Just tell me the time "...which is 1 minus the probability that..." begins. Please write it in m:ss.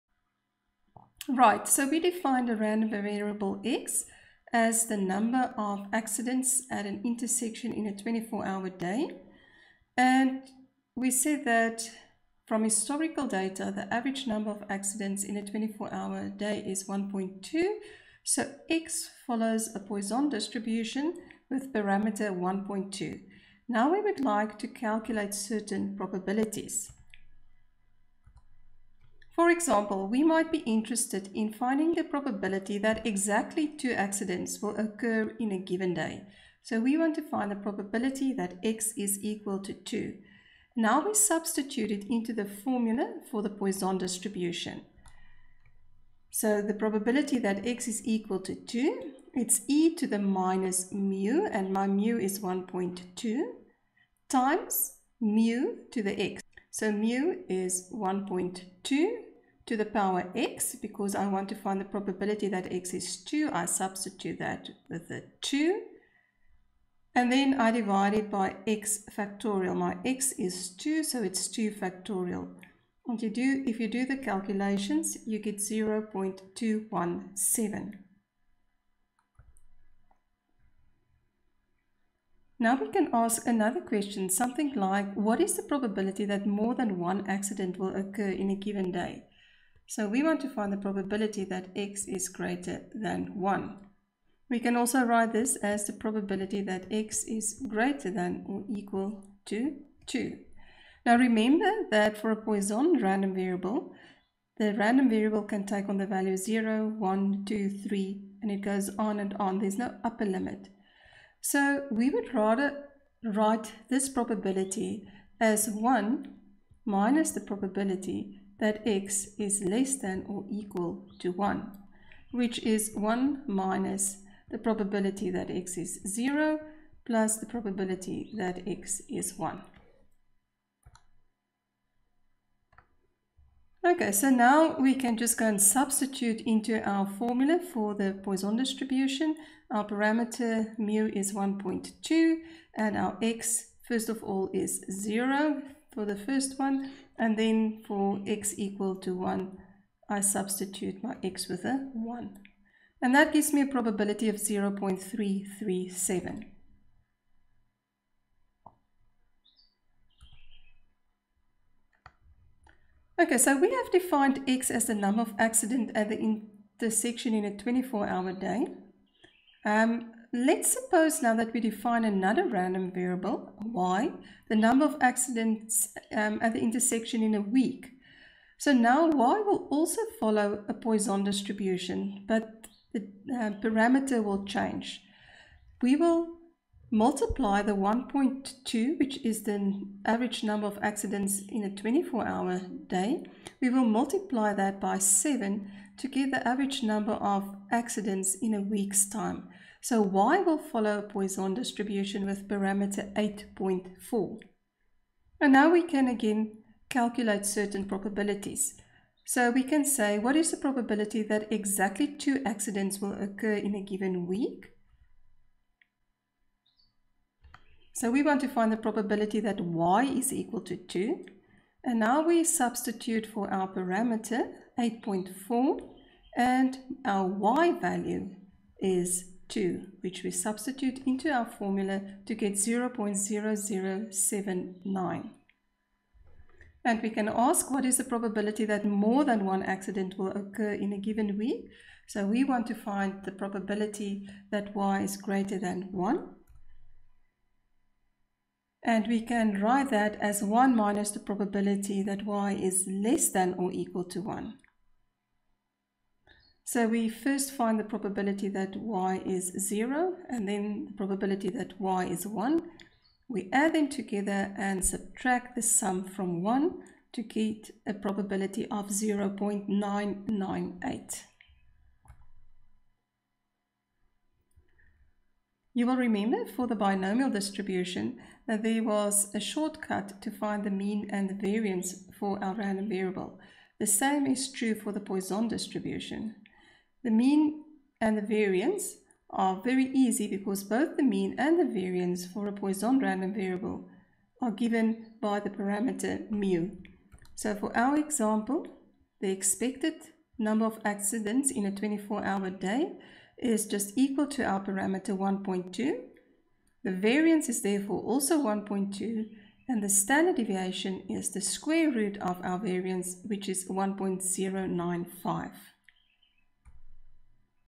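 2:02.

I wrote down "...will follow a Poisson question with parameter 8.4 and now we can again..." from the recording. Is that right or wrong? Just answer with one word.
wrong.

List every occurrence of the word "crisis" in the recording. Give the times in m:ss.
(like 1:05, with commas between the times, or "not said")
not said.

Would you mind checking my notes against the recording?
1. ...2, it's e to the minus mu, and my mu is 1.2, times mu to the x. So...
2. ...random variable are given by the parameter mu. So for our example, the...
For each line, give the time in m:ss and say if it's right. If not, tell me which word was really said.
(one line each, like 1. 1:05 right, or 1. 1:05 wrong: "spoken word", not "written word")
1. 0:48 right
2. 4:52 right.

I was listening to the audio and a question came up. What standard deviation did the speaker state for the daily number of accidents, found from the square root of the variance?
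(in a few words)
1.095.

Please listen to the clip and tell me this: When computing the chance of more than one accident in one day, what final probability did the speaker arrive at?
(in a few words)
0.337.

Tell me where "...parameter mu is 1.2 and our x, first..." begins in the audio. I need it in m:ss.
2:19.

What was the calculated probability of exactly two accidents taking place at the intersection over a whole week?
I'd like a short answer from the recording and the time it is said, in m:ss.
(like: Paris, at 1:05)
0.0079, at 3:52.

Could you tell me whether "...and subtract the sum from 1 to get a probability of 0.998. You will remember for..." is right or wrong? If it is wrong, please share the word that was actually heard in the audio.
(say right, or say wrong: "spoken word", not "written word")
right.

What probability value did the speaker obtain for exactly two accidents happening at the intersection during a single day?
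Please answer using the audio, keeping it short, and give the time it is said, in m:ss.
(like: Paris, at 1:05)
0.217, at 1:15.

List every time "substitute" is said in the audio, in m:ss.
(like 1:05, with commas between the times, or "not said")
0:41, 1:03, 2:15, 2:30, 3:42, 3:50.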